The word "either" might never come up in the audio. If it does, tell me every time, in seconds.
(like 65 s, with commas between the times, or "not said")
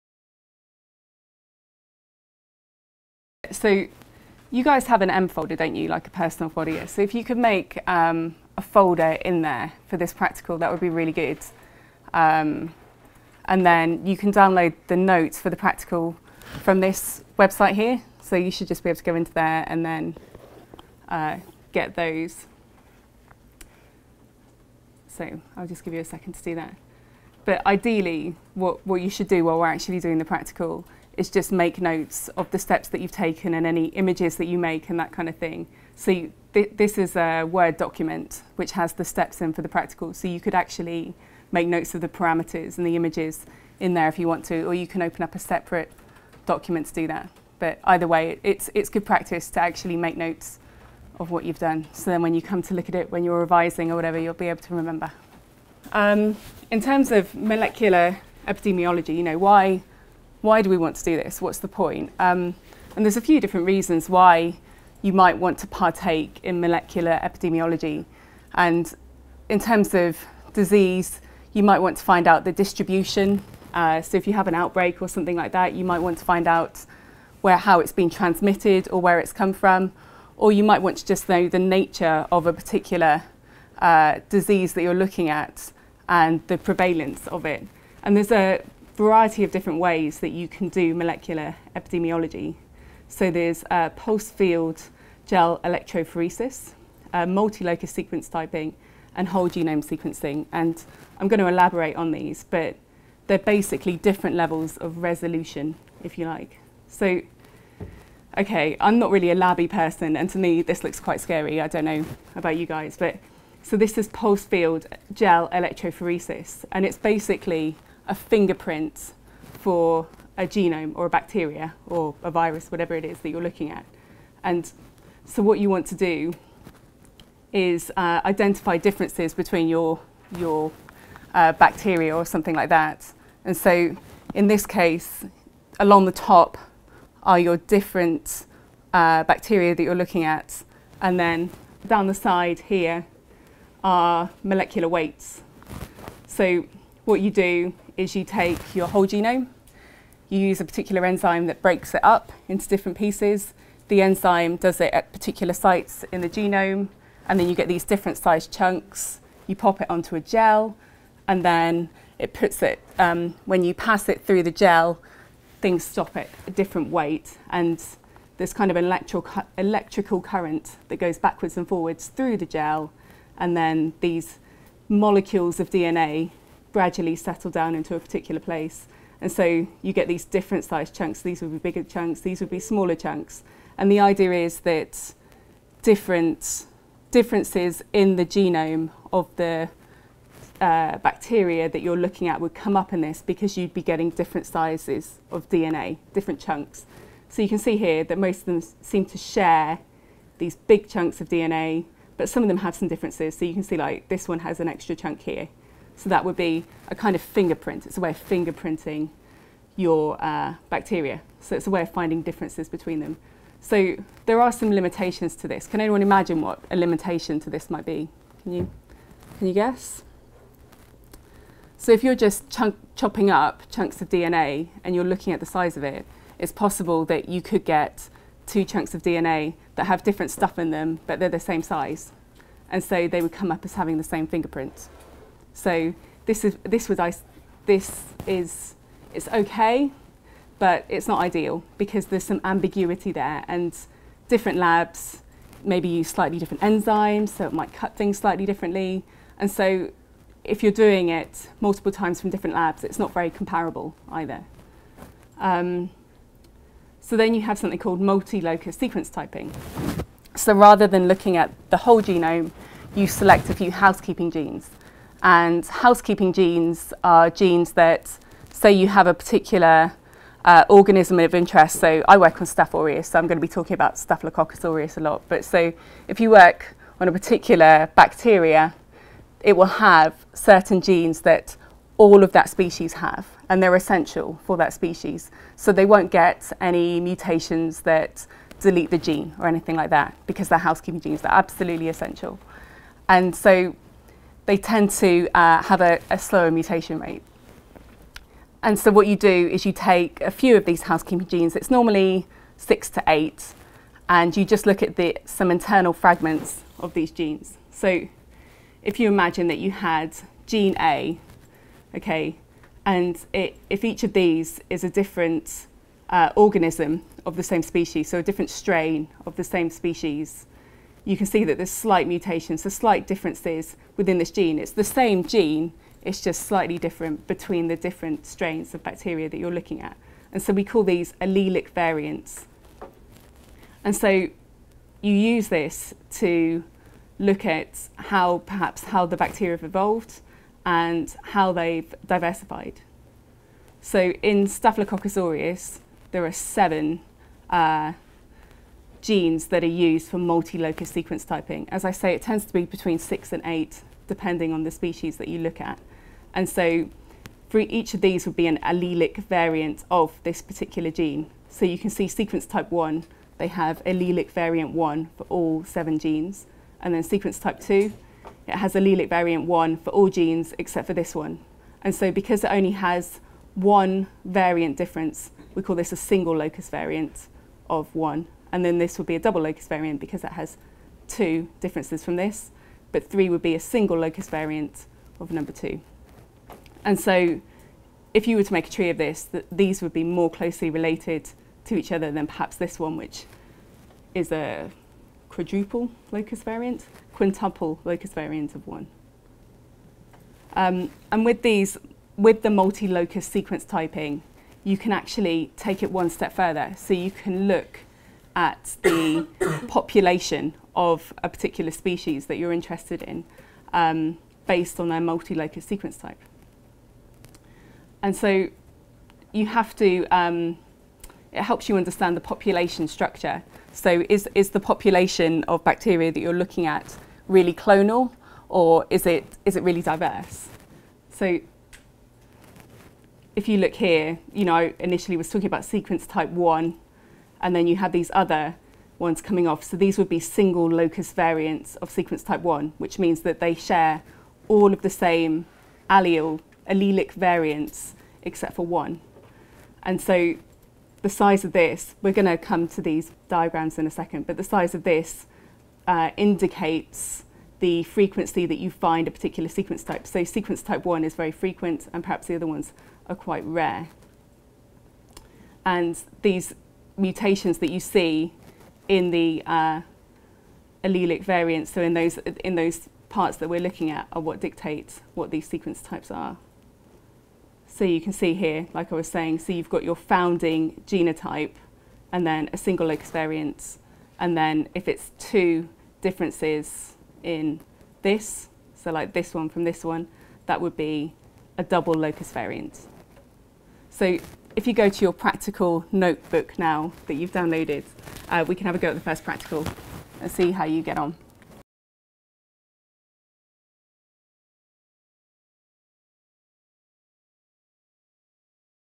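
47 s, 254 s.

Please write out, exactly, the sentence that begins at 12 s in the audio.
Um, and then you can download the notes for the practical from this website here.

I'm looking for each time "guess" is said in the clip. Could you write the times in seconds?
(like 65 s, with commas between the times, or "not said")
219 s.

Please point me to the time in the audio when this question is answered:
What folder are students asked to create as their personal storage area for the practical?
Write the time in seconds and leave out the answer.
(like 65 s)
5 s.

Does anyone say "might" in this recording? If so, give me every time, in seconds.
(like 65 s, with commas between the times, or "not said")
65 s, 71 s, 75 s, 80 s, 217 s, 247 s.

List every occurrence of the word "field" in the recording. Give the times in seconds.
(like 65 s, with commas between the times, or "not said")
94 s, 114 s.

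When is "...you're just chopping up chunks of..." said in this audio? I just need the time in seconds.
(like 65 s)
222 s.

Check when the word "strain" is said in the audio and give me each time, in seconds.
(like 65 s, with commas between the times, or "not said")
318 s, 328 s.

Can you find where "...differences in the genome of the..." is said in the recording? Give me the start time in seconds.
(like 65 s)
187 s.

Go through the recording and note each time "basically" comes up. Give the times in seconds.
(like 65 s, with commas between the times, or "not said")
103 s, 116 s.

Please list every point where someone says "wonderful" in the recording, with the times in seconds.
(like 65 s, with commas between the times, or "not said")
not said.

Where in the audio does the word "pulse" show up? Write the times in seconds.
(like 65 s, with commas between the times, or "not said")
93 s, 114 s.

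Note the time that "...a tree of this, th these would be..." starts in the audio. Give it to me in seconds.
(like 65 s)
388 s.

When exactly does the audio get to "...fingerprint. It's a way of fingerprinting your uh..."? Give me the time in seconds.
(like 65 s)
207 s.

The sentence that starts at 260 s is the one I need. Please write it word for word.
So rather than looking at the whole genome, you select a few housekeeping genes.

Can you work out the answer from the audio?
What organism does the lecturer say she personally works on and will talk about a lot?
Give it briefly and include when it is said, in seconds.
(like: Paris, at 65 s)
Staph aureus, at 272 s.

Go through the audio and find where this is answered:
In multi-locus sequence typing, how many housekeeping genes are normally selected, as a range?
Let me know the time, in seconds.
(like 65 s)
302 s.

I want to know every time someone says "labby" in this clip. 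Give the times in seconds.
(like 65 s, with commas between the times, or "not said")
109 s.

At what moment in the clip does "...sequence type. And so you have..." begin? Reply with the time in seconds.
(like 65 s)
415 s.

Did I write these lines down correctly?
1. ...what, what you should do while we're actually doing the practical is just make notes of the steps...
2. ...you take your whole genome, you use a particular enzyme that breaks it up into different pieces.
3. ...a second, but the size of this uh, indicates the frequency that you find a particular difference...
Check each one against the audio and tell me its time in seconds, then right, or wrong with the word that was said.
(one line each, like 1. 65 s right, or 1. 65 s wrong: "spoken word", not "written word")
1. 28 s right
2. 148 s right
3. 453 s wrong: "sequence", not "difference".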